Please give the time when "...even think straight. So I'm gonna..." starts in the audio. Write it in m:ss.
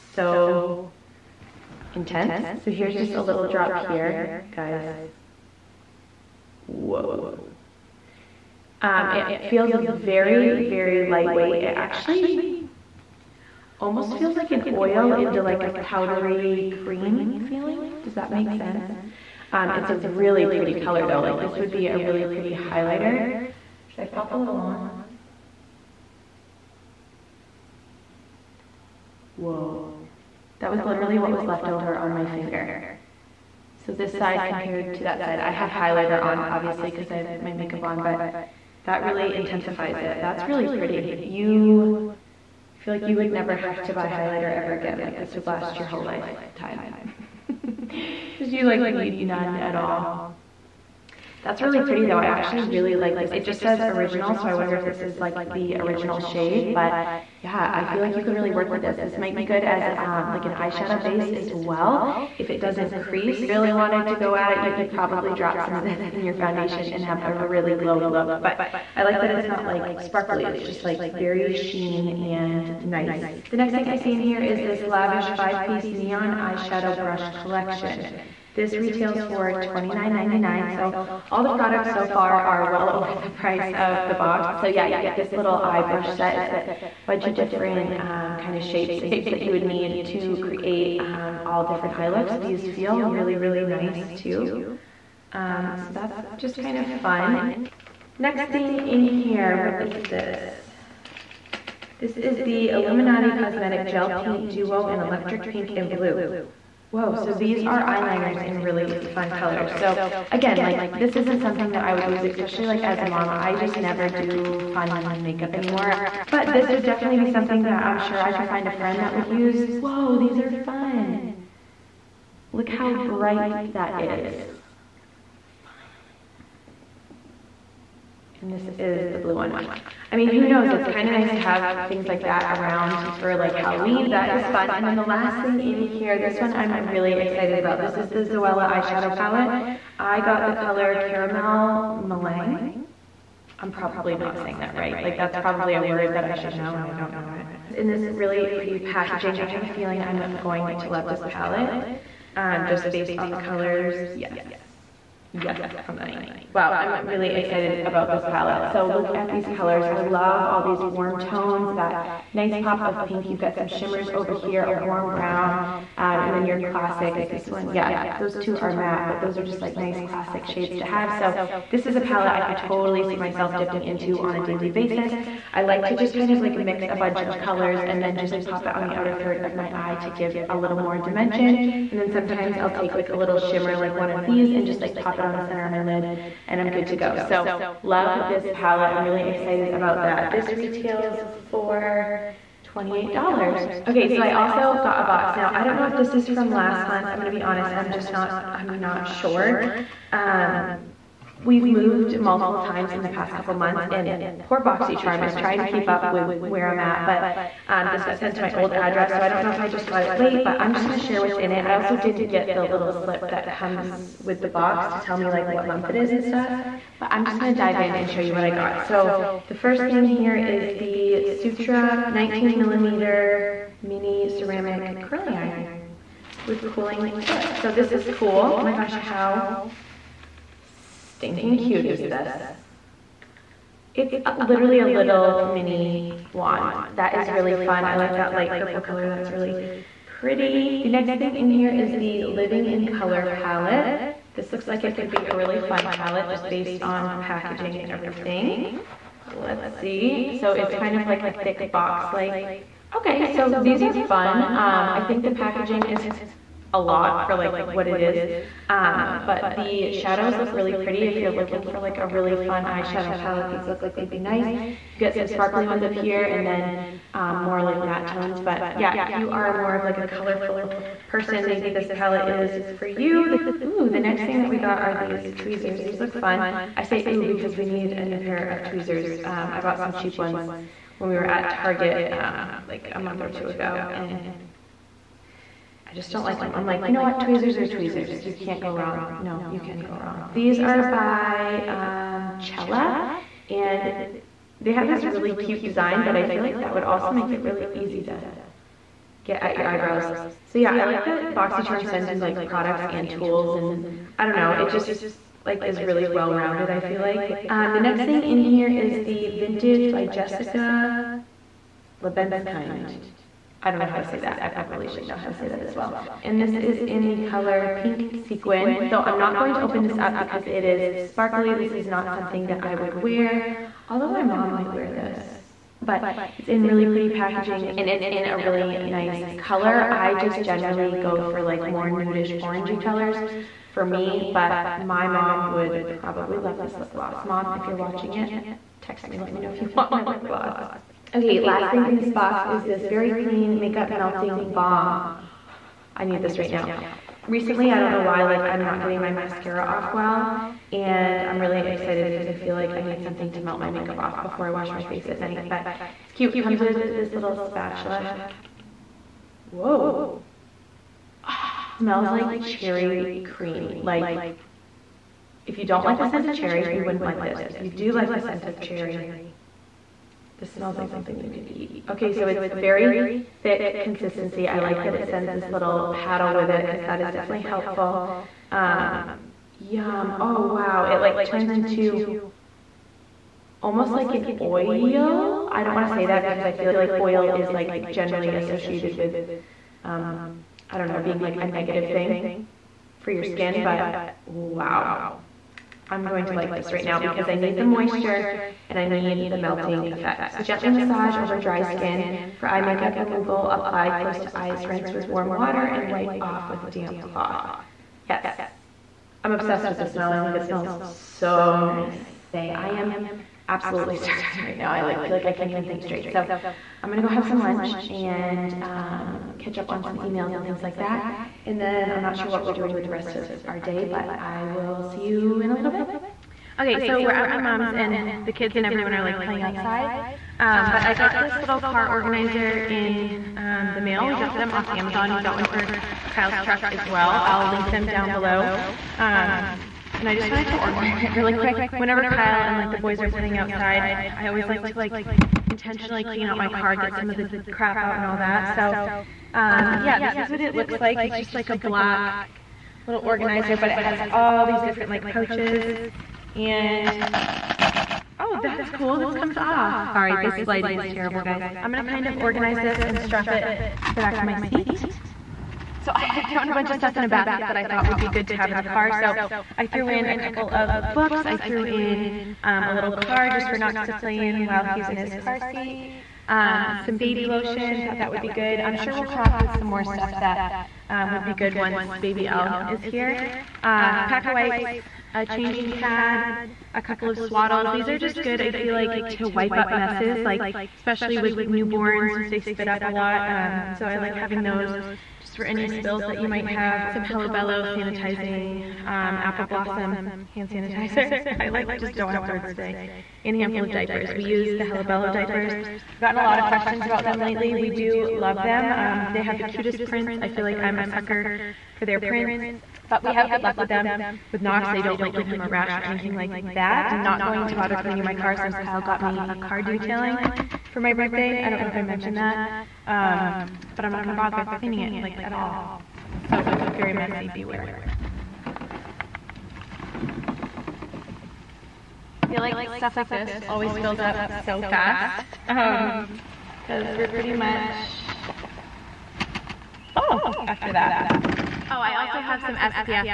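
6:55.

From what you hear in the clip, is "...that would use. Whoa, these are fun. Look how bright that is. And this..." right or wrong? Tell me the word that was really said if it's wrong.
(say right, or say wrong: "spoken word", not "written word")
right.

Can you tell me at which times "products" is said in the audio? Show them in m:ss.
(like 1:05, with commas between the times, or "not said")
1:21, 5:02.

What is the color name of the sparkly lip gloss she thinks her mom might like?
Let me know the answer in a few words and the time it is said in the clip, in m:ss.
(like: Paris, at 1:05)
Pink Sequin, at 5:17.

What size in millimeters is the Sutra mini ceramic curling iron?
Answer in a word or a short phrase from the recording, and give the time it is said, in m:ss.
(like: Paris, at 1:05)
19 millimeter, at 3:42.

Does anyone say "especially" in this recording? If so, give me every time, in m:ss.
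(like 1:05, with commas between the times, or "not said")
1:52, 8:10.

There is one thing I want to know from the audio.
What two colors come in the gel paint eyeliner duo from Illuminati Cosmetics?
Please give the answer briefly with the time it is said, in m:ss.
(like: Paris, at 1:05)
Electric Pink and Blue, at 1:44.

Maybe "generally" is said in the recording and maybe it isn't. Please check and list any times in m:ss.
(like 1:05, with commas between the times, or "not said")
5:30, 6:27.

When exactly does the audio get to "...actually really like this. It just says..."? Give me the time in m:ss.
0:52.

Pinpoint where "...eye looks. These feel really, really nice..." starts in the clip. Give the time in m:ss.
1:31.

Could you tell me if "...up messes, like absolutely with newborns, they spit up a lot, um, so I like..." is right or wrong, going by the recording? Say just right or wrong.
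wrong.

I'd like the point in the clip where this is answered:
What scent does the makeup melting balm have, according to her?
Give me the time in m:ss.
6:02.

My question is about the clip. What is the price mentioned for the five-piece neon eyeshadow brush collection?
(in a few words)
$29.99.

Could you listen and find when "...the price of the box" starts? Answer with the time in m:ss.
1:23.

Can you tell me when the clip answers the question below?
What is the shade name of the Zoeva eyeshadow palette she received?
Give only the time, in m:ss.
2:20.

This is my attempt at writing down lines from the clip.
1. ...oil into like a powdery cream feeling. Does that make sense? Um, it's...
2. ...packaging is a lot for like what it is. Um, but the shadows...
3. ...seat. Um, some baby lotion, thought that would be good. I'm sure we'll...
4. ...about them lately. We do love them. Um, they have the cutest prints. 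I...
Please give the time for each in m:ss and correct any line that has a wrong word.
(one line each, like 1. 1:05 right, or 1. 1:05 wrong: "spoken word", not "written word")
1. 0:14 right
2. 4:15 right
3. 7:55 right
4. 8:26 right.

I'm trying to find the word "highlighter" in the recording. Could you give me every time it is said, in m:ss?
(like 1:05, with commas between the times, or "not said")
0:22, 0:35, 0:44.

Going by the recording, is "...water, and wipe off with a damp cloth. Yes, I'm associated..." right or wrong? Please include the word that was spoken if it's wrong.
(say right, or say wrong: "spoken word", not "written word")
wrong: "obsessed", not "associated".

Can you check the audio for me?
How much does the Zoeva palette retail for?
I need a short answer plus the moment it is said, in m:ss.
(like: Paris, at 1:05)
$28, at 3:12.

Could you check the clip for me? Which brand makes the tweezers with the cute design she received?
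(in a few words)
Cella.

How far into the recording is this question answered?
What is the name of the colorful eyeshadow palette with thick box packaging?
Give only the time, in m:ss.
4:02.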